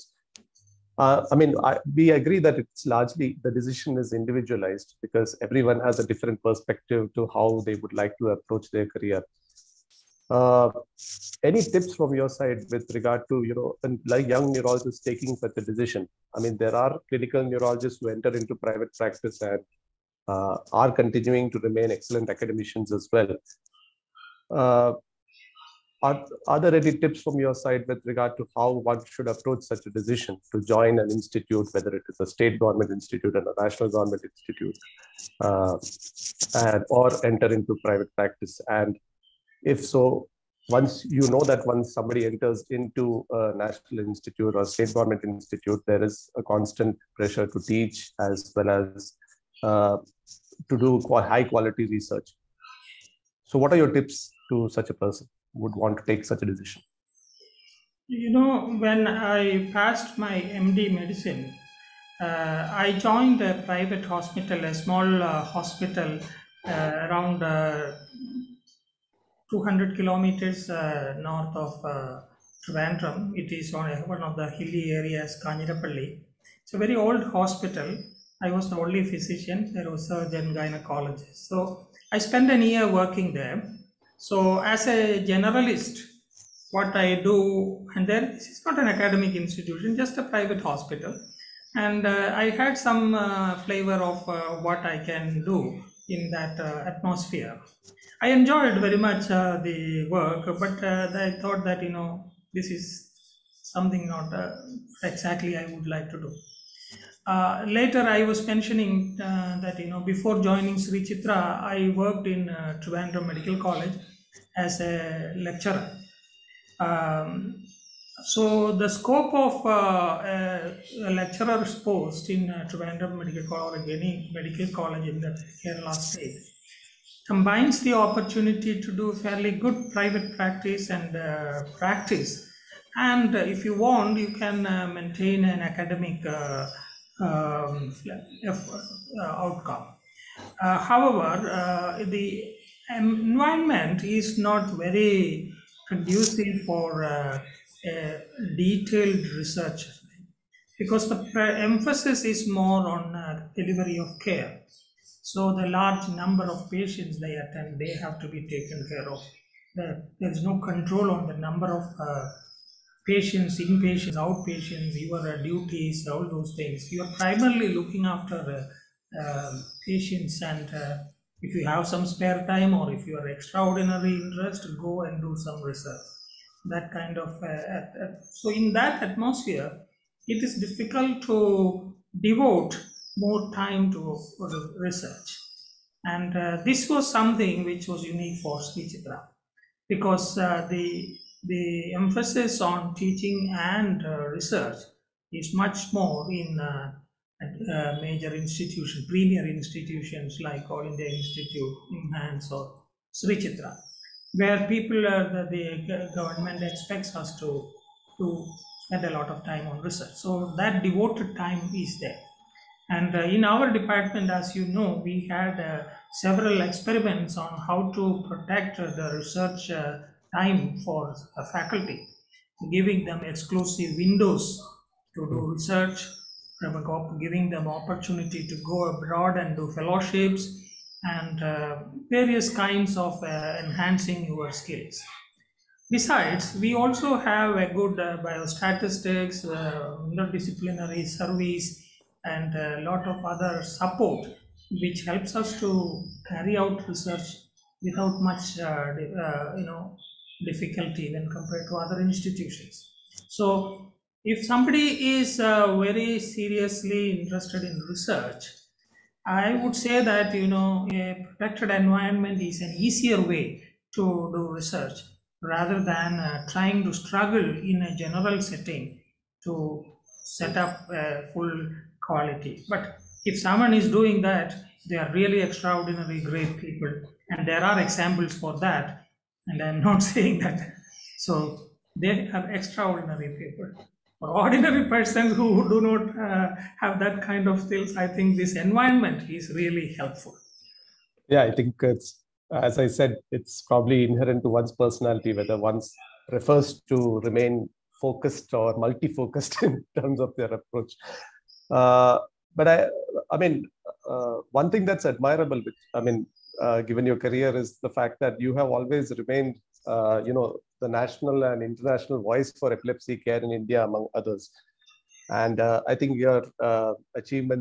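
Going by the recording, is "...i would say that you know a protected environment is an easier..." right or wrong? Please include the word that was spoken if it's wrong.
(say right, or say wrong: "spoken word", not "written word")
right.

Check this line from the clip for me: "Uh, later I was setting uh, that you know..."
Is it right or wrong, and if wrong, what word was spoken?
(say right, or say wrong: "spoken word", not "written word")
wrong: "mentioning", not "setting".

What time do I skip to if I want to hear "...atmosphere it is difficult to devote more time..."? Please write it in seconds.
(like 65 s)
179 s.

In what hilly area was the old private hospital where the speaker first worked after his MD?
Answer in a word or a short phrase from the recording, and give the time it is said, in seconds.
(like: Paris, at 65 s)
Kanjirapalli, at 75 s.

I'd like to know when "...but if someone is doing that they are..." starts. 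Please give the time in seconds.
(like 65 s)
272 s.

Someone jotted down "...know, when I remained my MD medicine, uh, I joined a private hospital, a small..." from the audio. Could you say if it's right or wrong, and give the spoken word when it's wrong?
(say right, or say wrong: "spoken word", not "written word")
wrong: "passed", not "remained".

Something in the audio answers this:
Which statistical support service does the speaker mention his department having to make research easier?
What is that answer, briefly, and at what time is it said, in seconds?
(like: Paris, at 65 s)
biostatistics, at 238 s.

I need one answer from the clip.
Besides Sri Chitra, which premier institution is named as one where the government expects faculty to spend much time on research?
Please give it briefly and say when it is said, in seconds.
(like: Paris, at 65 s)
All India Institute, at 200 s.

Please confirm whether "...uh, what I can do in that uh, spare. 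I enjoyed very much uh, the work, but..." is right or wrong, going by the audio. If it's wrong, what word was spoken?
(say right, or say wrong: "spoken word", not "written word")
wrong: "atmosphere", not "spare".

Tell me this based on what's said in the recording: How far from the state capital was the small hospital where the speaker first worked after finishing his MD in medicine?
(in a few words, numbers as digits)
200 kilometers.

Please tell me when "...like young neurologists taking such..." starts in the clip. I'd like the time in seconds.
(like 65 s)
14 s.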